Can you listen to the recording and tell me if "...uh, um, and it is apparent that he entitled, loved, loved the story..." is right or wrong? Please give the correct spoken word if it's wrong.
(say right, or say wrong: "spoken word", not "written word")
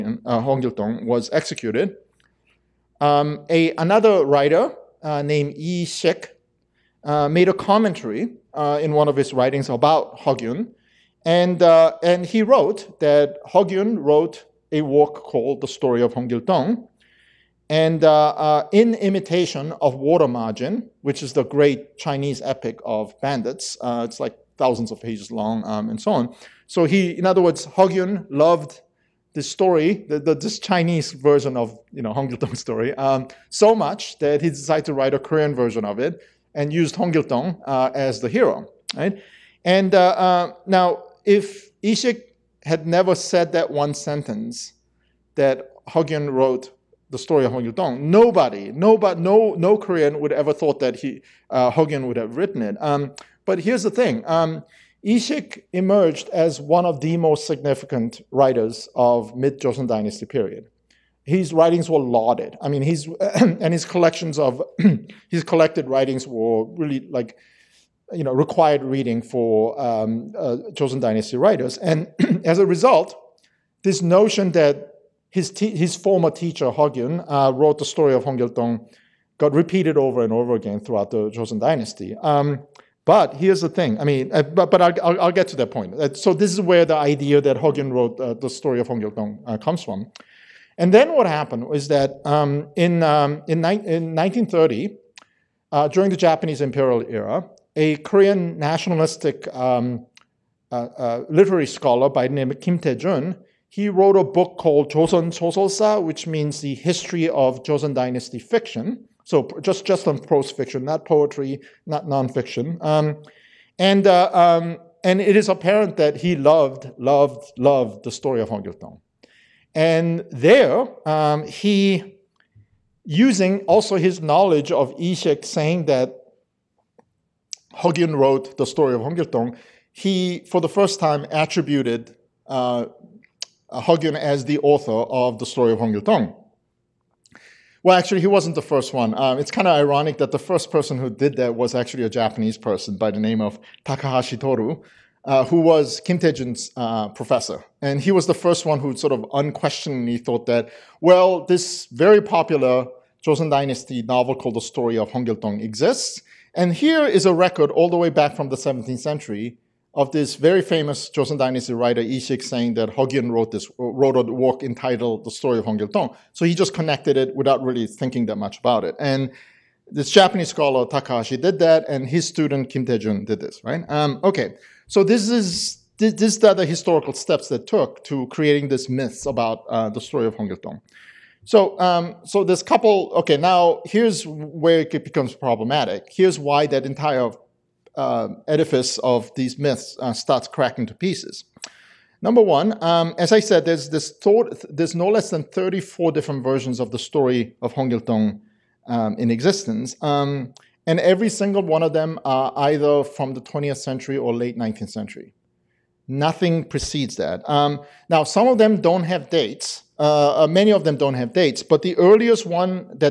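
wrong: "loved", not "entitled".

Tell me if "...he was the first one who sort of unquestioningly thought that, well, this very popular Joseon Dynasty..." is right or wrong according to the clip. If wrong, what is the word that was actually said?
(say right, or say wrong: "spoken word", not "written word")
right.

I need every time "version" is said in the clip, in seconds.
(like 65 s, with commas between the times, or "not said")
31 s, 35 s, 196 s.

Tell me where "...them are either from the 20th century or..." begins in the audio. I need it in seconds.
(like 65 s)
201 s.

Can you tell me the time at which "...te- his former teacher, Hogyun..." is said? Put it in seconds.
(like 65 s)
75 s.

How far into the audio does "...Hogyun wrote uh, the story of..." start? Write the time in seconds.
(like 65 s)
87 s.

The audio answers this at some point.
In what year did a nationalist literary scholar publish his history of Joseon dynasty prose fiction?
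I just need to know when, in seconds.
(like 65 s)
94 s.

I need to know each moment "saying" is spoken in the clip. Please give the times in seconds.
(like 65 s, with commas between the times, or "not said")
125 s, 162 s.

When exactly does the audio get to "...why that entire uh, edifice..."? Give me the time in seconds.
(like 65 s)
186 s.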